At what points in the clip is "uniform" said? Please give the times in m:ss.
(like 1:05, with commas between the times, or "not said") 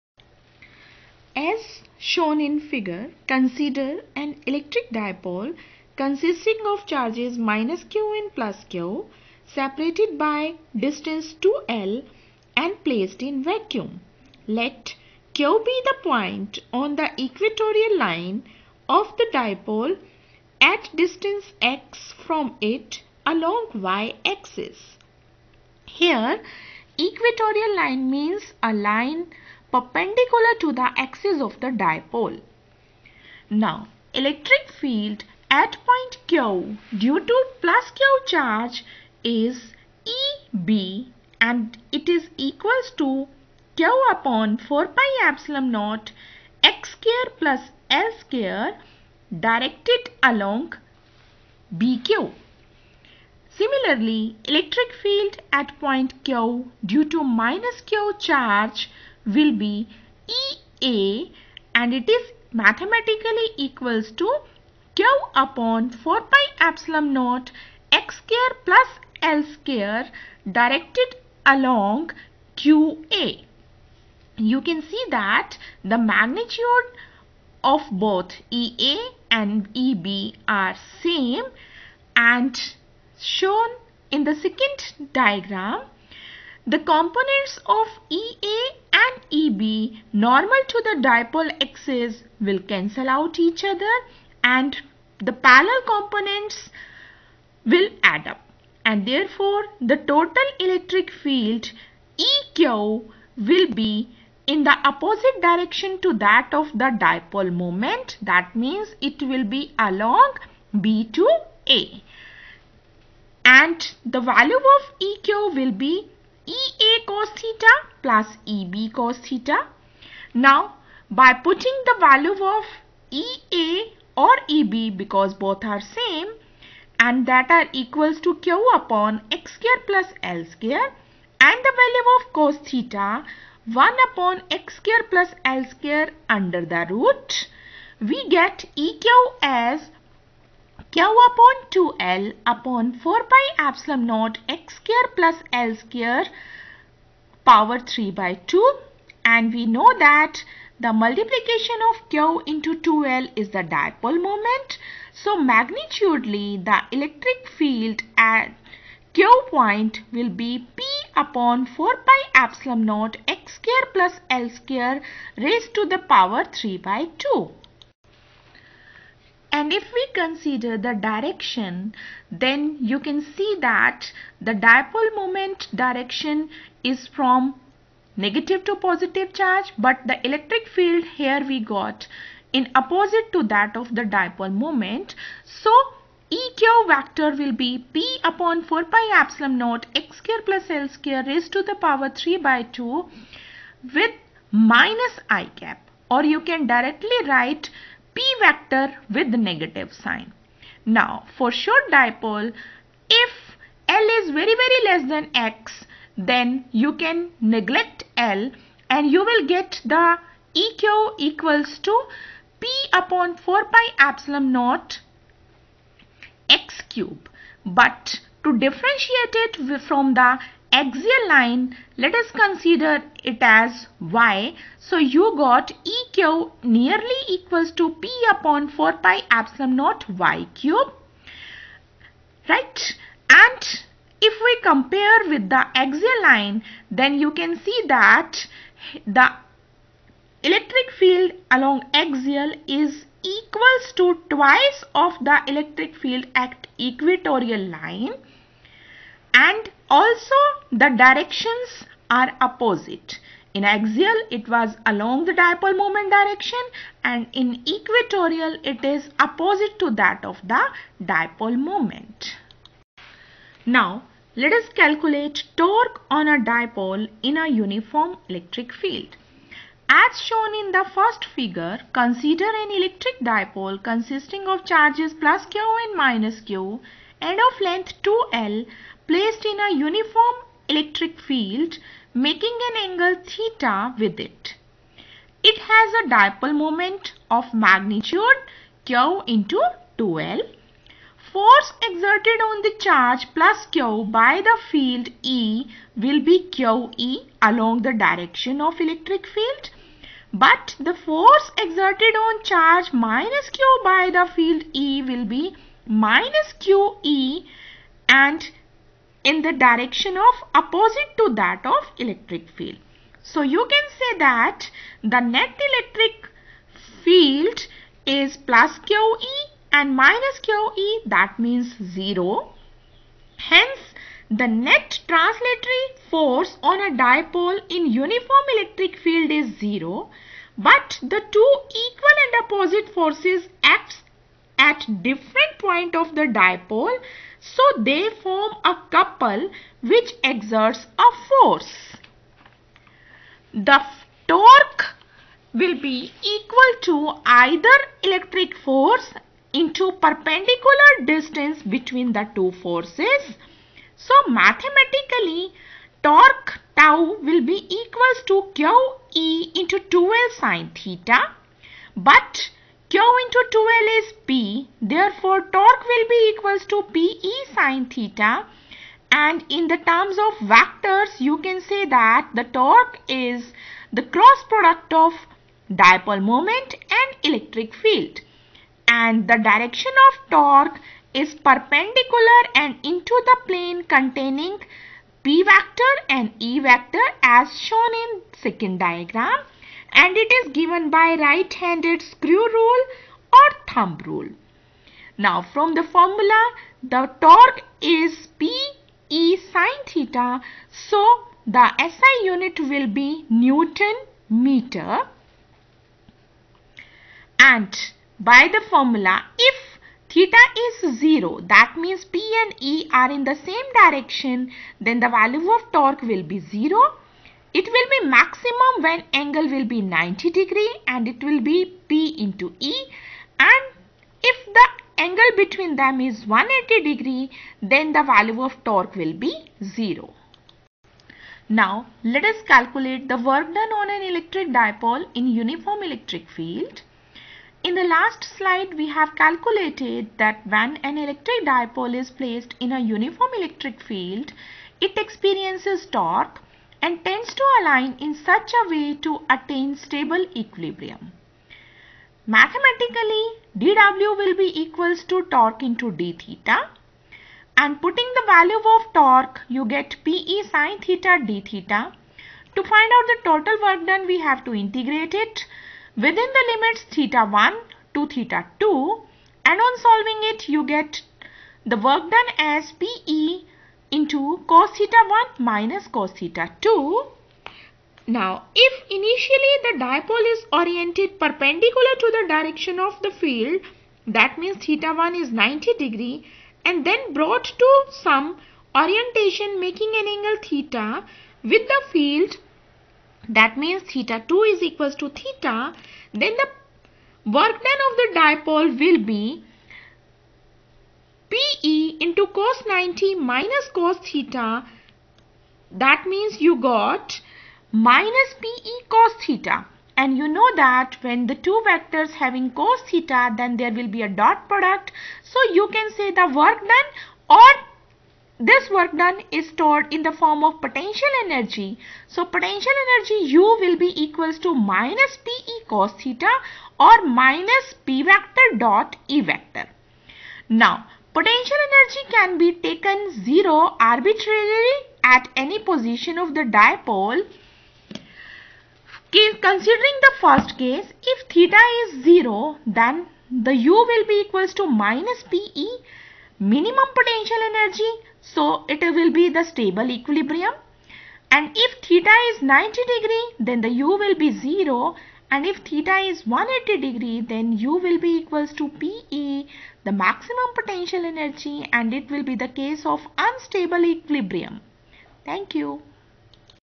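4:27, 4:39, 5:27, 7:15, 7:22.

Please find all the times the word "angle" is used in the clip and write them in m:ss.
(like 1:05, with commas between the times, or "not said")
4:42, 6:59, 7:05, 8:10.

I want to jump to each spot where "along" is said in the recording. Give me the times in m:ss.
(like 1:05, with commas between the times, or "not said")
0:23, 0:50, 1:11, 1:49, 4:01, 4:14, 4:57.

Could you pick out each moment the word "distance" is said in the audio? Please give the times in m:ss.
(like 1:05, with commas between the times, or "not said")
0:10, 0:20, 5:51.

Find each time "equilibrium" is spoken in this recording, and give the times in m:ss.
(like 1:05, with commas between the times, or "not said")
7:30, 9:09, 9:23.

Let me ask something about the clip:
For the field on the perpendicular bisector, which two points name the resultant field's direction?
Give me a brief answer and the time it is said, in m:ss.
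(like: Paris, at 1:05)
B to A, at 1:49.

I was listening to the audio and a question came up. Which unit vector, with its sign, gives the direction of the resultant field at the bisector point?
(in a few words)
minus i cap.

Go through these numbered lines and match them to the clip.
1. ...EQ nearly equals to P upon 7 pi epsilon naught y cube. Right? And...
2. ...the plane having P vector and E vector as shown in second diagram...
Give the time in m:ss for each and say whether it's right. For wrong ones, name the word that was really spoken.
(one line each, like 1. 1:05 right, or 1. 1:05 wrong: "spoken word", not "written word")
1. 3:45 wrong: "4", not "7"
2. 6:23 wrong: "containing", not "having".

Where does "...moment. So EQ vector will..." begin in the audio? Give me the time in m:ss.
3:04.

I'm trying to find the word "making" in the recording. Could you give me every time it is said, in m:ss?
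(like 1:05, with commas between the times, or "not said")
4:42, 8:09.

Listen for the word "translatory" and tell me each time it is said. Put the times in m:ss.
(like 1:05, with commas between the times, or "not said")
5:25.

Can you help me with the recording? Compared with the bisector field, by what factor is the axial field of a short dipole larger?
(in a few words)
twice.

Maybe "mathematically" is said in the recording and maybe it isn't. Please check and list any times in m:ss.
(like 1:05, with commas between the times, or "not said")
1:02, 5:54, 7:32.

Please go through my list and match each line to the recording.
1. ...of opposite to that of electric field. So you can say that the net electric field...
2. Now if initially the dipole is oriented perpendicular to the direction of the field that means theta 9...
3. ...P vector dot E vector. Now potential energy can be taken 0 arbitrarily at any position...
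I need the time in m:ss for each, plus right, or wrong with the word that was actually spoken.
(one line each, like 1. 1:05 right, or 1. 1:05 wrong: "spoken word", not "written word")
1. 5:10 right
2. 7:58 wrong: "1", not "9"
3. 8:47 right.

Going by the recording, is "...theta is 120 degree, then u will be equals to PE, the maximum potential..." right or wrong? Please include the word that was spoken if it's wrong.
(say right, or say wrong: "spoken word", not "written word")
wrong: "180", not "120".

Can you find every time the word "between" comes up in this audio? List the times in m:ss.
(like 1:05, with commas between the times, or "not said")
5:51, 7:05.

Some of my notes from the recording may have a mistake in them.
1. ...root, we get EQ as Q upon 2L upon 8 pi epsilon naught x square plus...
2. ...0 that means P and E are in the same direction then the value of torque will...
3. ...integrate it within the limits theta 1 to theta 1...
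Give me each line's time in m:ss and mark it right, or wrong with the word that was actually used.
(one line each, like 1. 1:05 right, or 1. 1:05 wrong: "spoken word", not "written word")
1. 2:16 wrong: "4", not "8"
2. 6:51 right
3. 7:44 wrong: "2", not "1".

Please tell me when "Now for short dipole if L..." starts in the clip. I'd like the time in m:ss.
3:20.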